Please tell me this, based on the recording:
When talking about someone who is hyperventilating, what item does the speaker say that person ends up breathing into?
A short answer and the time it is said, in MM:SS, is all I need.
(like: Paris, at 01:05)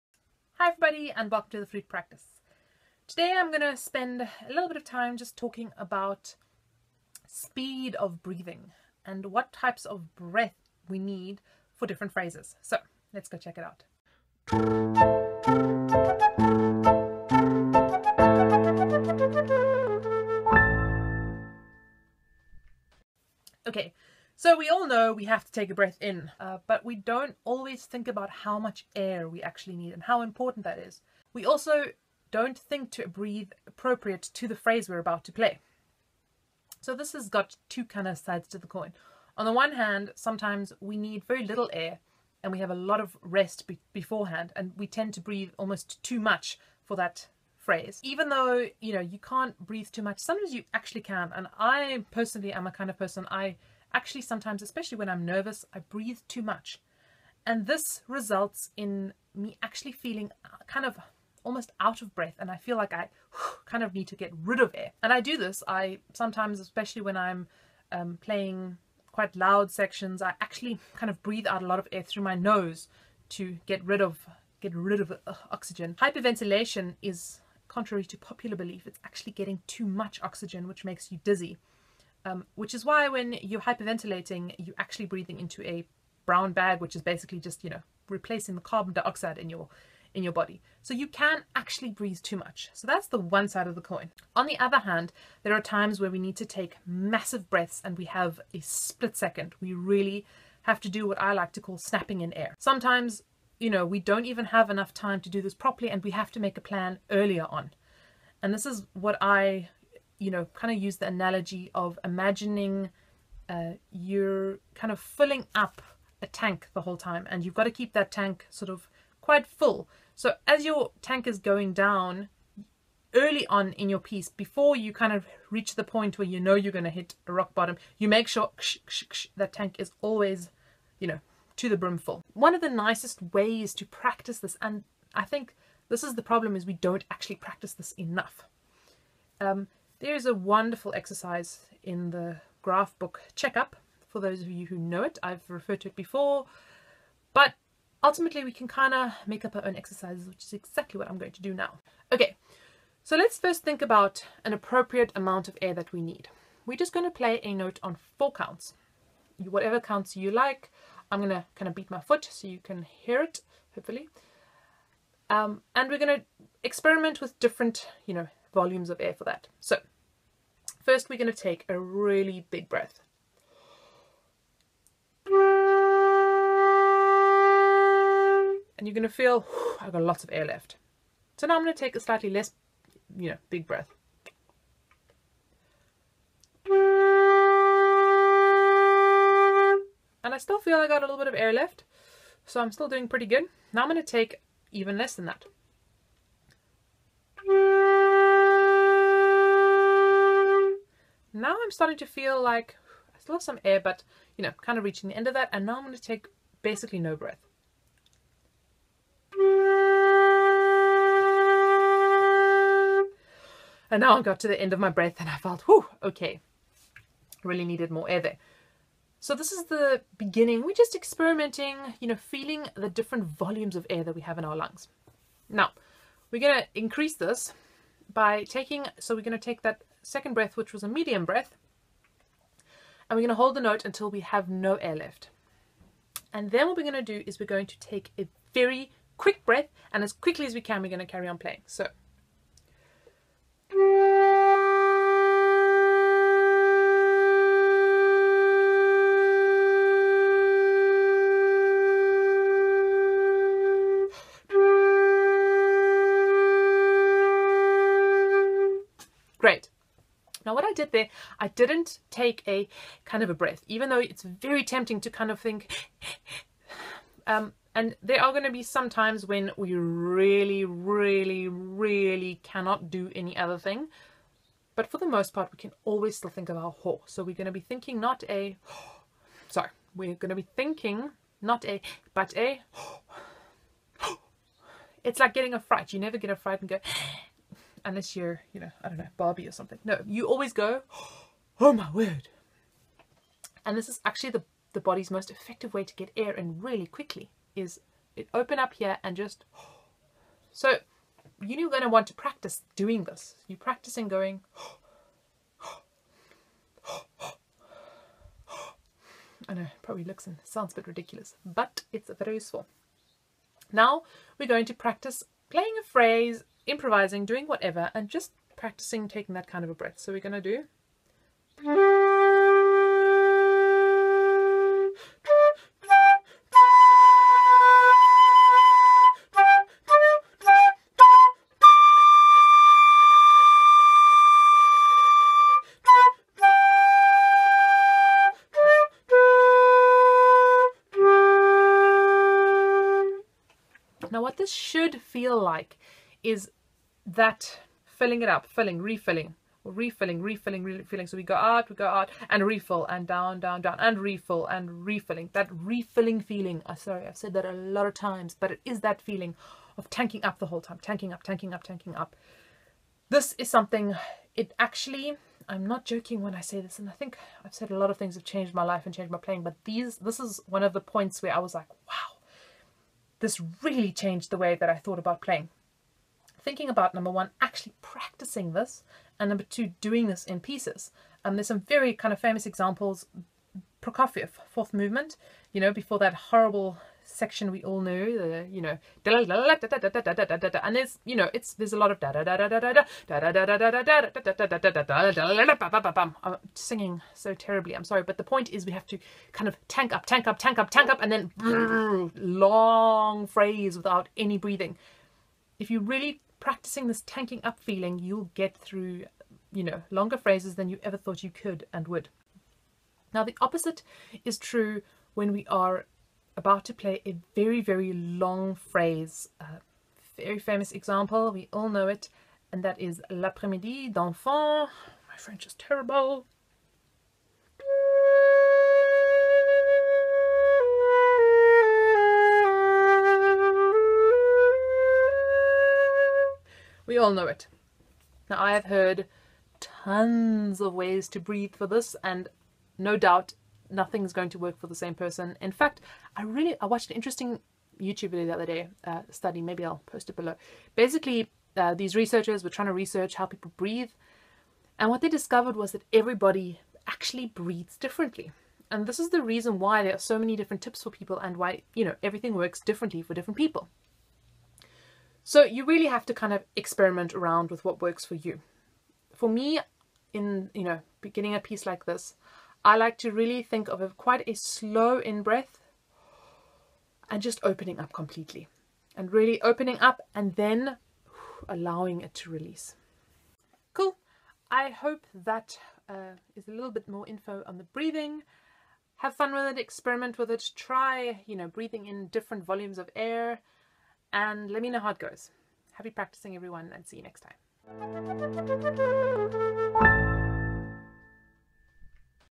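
a brown bag, at 01:26.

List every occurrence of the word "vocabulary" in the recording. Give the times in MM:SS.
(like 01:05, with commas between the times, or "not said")
not said.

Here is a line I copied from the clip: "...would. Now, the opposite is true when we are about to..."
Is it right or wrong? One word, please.
right.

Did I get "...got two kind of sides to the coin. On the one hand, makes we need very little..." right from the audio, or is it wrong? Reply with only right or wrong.
wrong.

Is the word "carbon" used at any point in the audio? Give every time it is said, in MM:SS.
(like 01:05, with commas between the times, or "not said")
01:28.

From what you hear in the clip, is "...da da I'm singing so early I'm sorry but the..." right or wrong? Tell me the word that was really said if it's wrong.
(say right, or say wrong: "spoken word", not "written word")
wrong: "terribly", not "early".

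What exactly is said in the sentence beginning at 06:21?
And there's some very kind of famous examples.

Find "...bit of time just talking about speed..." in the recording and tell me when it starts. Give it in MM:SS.
00:04.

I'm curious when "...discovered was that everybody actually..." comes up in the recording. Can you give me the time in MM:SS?
07:35.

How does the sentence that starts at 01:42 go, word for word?
Sometimes, you know, we don't even have enough time to do this properly and we have to make a plan earlier on.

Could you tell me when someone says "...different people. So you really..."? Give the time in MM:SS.
07:43.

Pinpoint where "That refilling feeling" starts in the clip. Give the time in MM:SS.
05:55.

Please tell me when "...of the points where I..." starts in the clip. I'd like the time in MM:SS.
06:10.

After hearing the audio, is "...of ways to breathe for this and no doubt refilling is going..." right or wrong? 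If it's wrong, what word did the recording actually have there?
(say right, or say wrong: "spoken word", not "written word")
wrong: "nothing", not "refilling".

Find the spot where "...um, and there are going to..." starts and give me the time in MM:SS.
04:27.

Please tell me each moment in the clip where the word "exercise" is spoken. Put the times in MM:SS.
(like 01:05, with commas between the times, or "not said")
02:20, 02:29.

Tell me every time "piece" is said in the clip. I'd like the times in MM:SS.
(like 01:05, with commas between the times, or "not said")
02:03, 06:20, 07:51.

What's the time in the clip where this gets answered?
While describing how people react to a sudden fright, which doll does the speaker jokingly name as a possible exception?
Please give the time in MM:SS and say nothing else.
04:49.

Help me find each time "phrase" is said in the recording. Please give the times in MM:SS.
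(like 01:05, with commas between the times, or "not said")
00:12, 00:34, 00:47, 05:15, 06:43, 06:50, 06:58.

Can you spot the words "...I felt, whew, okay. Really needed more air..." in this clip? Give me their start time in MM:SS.
03:35.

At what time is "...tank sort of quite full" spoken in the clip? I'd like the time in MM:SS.
01:58.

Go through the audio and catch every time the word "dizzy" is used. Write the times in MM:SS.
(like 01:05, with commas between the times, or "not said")
01:21.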